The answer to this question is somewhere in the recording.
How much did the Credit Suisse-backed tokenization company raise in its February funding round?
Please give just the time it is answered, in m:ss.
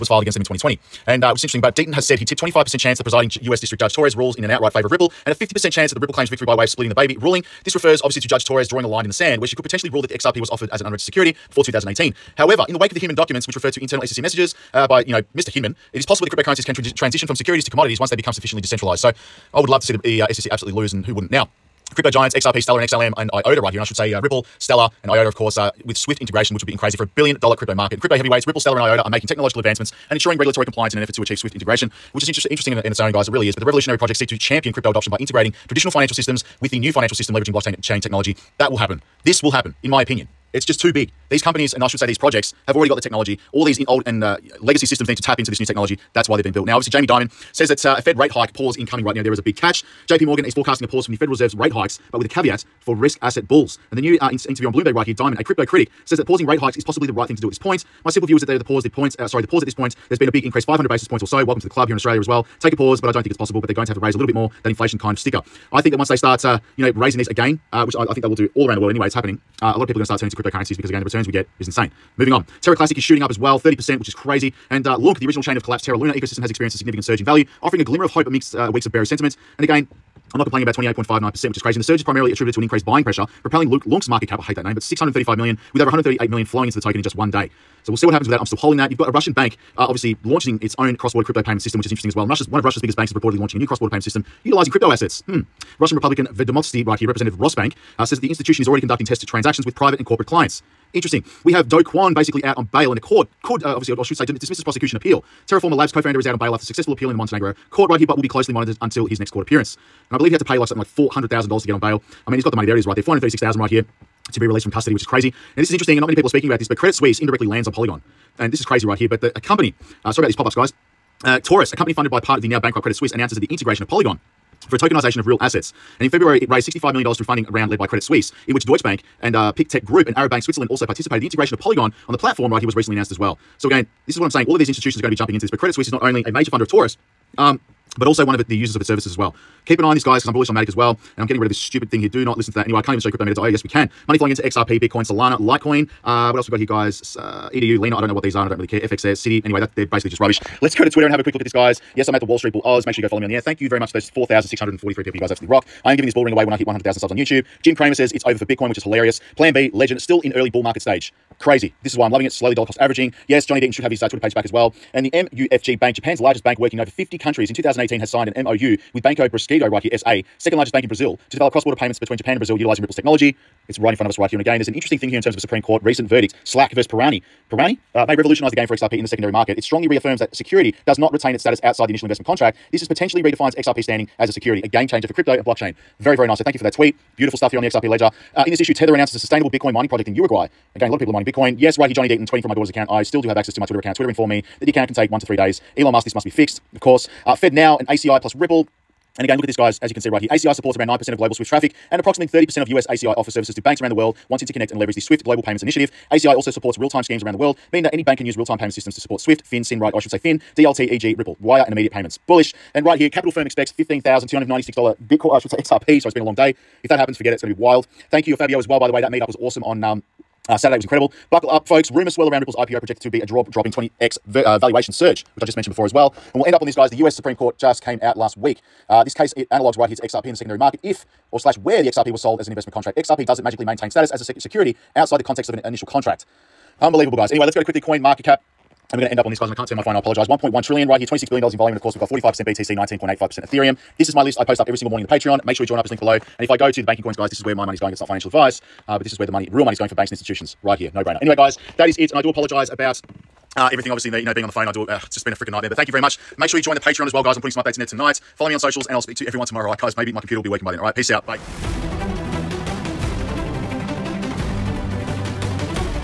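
2:06.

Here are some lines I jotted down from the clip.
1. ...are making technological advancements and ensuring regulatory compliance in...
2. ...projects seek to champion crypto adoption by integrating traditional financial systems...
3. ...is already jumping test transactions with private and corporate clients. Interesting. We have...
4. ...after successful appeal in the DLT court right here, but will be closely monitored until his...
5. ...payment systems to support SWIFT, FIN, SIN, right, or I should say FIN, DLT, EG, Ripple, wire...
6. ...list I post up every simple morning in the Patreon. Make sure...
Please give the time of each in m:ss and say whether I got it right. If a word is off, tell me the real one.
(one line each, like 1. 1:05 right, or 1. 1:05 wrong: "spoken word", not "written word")
1. 0:29 right
2. 0:33 right
3. 1:38 wrong: "conducting", not "jumping"
4. 1:46 wrong: "Montenegro", not "DLT"
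5. 3:28 right
6. 4:04 wrong: "single", not "simple".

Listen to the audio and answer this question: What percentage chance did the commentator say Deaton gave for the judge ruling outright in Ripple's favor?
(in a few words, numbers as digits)
25%.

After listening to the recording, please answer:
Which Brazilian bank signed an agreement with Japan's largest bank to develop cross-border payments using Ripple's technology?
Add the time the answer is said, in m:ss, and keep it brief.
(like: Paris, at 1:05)
Banco Bradesco, at 2:49.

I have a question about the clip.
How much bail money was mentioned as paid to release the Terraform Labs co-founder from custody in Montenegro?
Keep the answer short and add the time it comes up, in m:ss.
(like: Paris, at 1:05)
$436,000, at 1:53.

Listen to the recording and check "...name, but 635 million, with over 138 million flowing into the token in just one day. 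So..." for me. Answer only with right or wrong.
right.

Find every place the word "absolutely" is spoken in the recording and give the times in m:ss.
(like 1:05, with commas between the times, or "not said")
0:20, 2:35.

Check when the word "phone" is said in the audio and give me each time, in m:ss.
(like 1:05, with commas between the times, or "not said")
3:59, 4:14.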